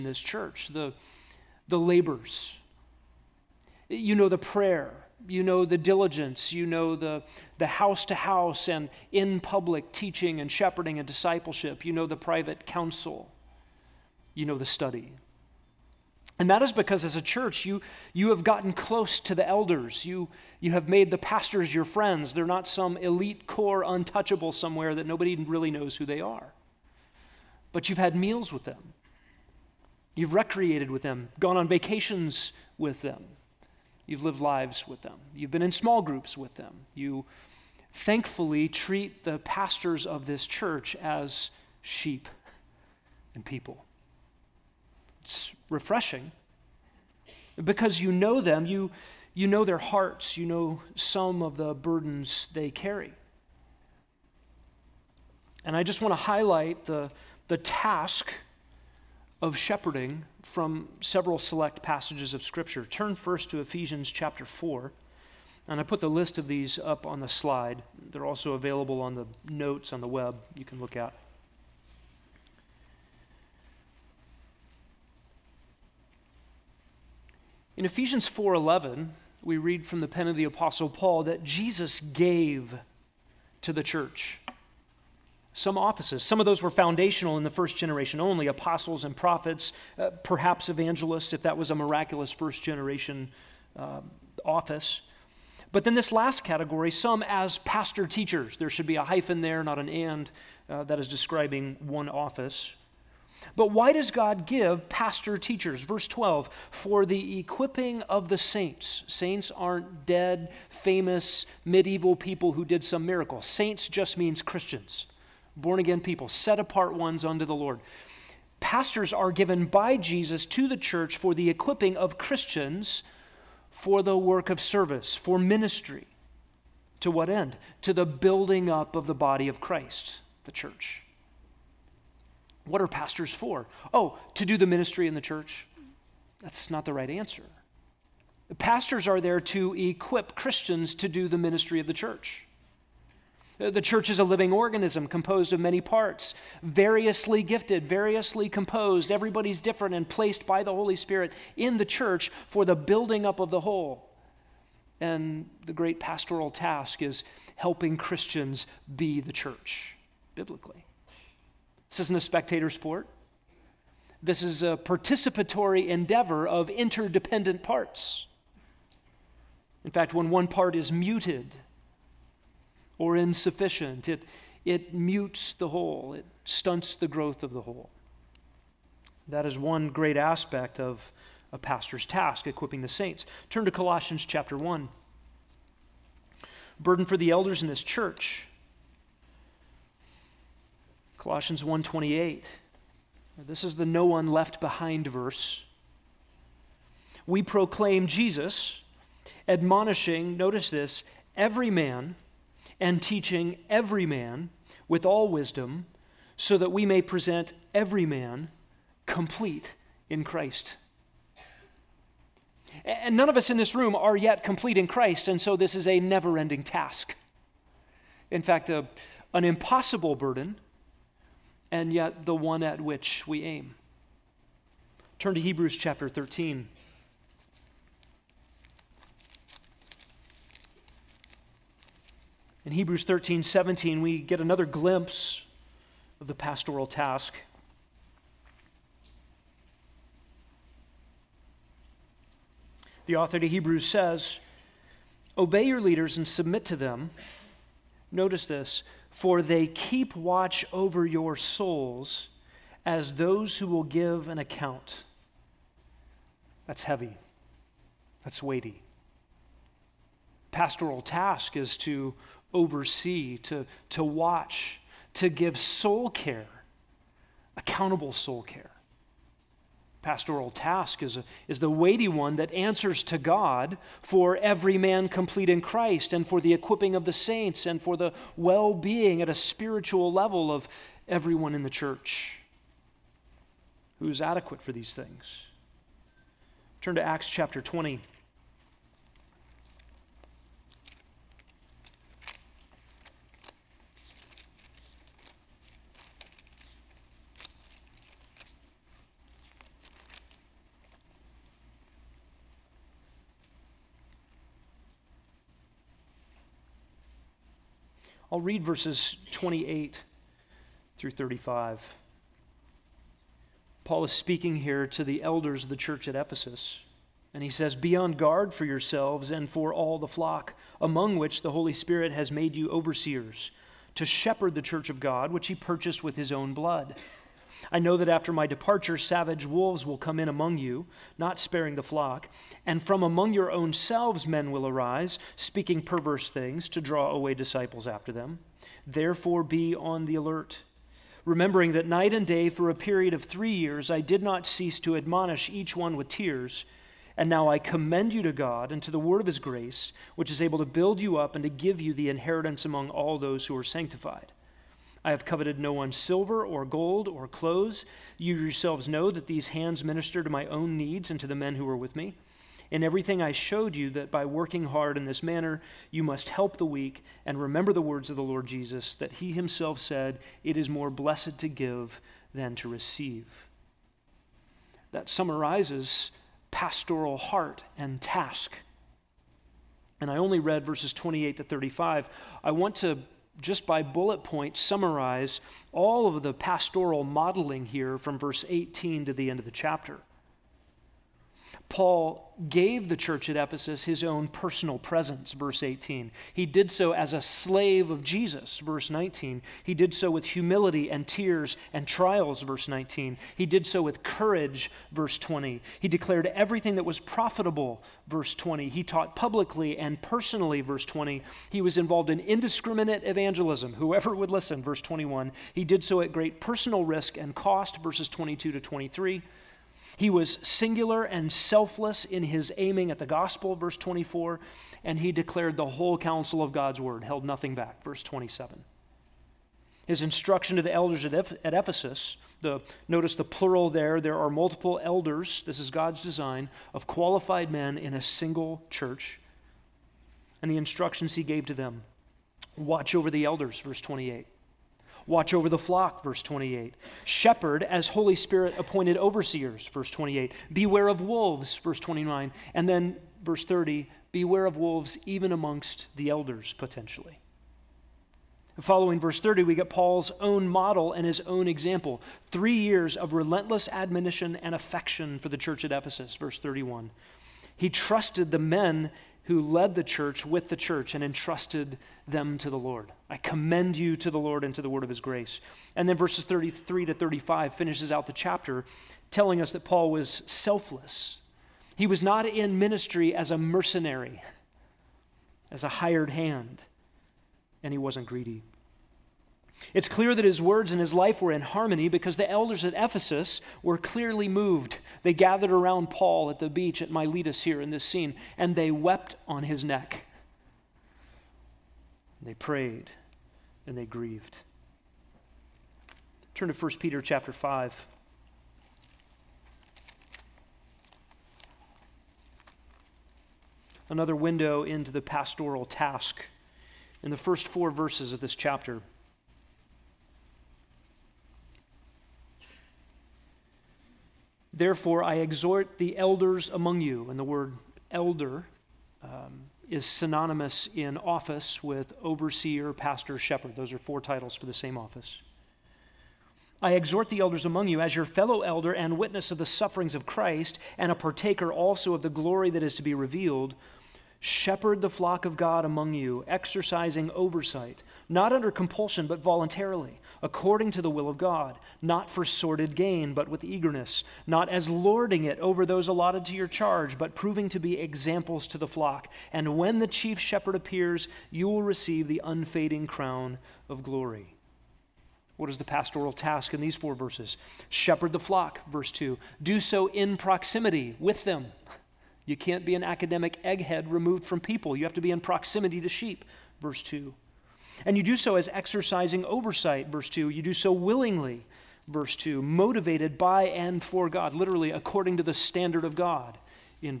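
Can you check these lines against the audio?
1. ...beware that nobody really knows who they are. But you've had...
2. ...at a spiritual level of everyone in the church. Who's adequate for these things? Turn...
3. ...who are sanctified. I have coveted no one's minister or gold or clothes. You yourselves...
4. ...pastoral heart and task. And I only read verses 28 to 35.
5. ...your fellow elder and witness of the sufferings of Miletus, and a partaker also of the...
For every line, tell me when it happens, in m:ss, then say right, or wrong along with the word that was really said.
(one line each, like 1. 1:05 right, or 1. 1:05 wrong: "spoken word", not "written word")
1. 0:24 wrong: "somewhere", not "beware"
2. 4:39 right
3. 5:53 wrong: "silver", not "minister"
4. 6:16 right
5. 8:57 wrong: "Christ", not "Miletus".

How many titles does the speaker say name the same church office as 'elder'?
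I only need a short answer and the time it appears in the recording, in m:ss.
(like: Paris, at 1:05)
4, at 8:53.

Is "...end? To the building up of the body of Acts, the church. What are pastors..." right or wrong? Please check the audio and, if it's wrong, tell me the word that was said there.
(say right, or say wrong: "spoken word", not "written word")
wrong: "Christ", not "Acts".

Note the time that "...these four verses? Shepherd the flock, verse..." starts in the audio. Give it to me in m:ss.
9:26.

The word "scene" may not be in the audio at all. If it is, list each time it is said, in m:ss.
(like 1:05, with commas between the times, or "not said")
8:17.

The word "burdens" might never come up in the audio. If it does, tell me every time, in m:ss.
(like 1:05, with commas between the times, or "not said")
0:51, 3:06, 3:40.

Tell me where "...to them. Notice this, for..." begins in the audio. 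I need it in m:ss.
4:06.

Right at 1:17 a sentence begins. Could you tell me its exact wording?
In Ephesians 4:11, we read from the pen of the apostle Paul that Jesus gave to the church some offices.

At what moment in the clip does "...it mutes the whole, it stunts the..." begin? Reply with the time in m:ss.
2:54.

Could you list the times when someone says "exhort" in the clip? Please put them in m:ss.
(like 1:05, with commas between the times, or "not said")
8:45, 8:56.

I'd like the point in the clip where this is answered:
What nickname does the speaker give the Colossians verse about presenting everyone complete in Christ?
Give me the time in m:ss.
3:13.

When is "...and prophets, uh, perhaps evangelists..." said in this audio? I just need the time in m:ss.
1:29.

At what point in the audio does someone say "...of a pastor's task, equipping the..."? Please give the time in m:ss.
3:00.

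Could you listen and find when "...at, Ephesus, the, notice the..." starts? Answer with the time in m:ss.
7:11.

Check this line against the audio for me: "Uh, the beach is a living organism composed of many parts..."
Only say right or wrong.
wrong.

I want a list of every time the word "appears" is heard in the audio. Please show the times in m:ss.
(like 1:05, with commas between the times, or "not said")
9:20.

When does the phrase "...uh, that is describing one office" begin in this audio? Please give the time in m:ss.
1:40.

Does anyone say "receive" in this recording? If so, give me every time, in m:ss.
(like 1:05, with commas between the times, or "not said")
6:12, 9:21.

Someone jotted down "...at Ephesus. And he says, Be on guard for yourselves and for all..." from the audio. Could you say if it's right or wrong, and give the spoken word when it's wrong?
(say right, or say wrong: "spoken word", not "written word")
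right.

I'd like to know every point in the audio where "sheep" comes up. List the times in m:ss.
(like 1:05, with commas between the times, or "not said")
0:41, 9:35.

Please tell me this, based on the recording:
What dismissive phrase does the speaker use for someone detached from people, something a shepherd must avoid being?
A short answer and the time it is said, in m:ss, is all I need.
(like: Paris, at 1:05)
Academic egghead, at 9:32.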